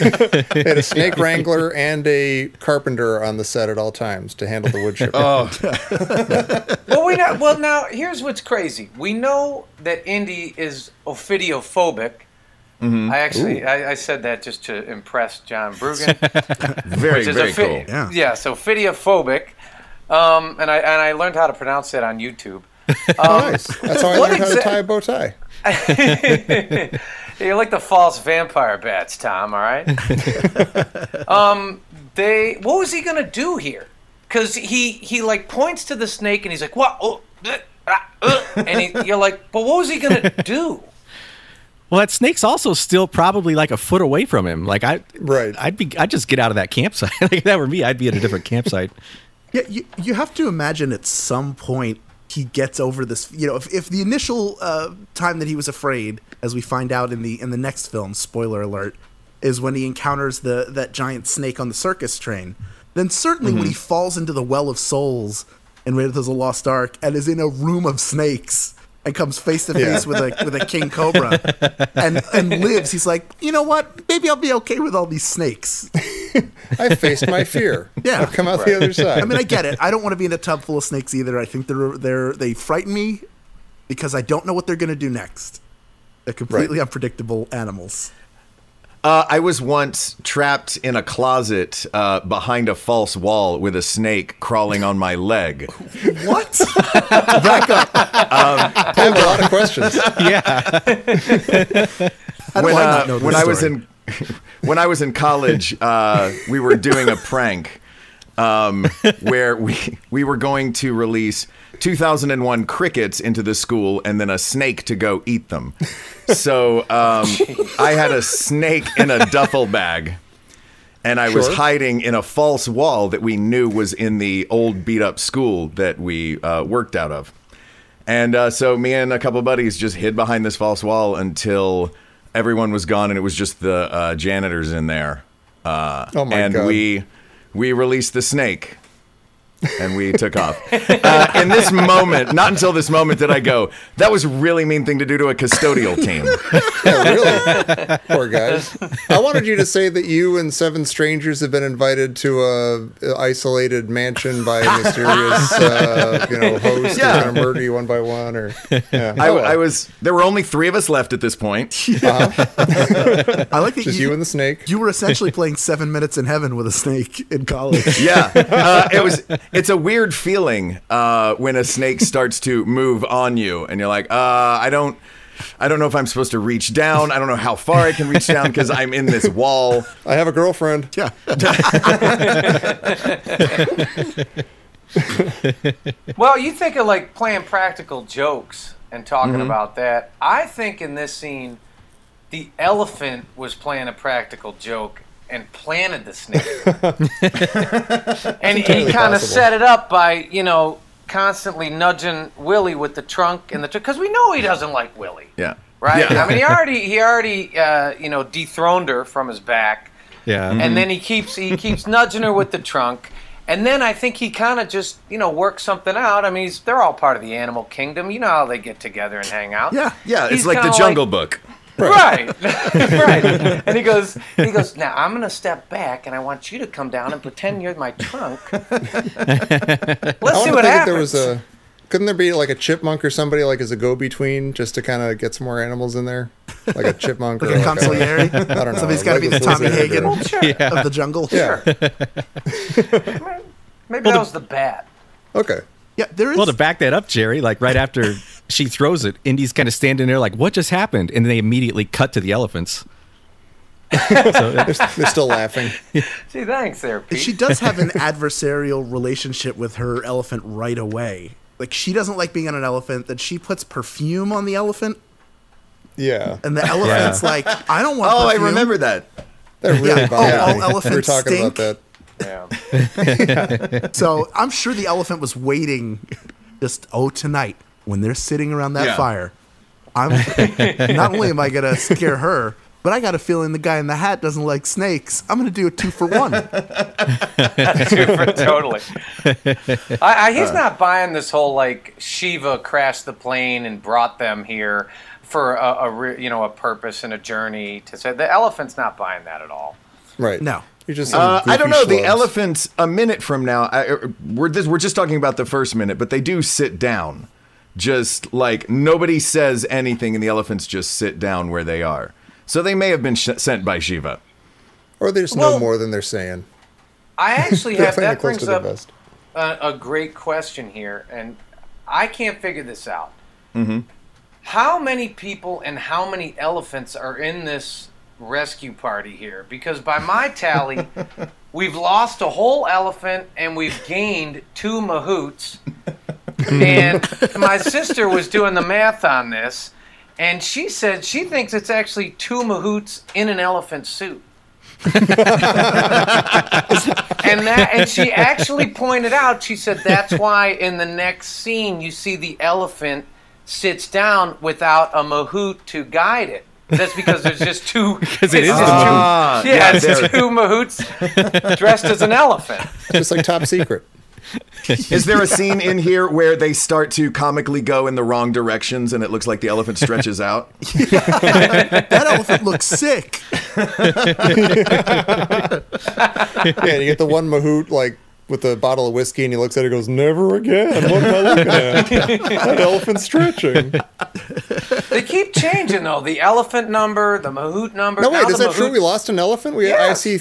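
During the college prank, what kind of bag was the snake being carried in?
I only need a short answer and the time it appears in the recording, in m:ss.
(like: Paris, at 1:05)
Duffel bag, at 1:59.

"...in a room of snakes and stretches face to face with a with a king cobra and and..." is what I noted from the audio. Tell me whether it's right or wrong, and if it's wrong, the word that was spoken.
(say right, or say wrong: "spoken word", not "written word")
wrong: "comes", not "stretches".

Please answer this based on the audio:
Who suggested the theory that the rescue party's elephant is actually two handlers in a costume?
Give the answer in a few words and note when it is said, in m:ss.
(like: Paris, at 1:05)
My sister, at 5:37.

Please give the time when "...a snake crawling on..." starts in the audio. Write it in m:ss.
1:33.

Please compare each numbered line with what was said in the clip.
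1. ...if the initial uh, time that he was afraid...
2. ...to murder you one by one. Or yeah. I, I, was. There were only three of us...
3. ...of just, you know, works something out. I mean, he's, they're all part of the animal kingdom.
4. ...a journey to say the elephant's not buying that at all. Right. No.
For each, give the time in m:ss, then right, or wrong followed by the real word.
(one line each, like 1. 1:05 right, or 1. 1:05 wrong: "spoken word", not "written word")
1. 0:53 right
2. 2:37 right
3. 3:34 right
4. 4:57 right.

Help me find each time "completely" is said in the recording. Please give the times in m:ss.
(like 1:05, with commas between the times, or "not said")
1:26.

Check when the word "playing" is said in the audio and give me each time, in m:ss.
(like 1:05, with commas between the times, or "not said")
2:45, 3:07, 3:13.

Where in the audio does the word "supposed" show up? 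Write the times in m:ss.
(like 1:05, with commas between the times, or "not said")
2:56.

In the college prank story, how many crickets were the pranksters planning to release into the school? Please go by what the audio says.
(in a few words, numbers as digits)
2001.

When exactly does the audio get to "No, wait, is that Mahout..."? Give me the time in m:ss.
6:28.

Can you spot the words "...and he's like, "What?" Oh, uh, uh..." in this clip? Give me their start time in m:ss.
0:36.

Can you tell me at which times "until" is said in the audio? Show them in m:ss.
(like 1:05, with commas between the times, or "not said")
2:11, 2:22.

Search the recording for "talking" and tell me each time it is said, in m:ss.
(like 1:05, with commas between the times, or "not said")
3:09, 4:31, 5:04.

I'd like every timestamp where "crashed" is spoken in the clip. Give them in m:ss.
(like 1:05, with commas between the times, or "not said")
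4:52.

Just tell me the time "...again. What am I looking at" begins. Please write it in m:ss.
6:20.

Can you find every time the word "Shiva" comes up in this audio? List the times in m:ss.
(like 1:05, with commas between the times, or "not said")
4:51, 5:13.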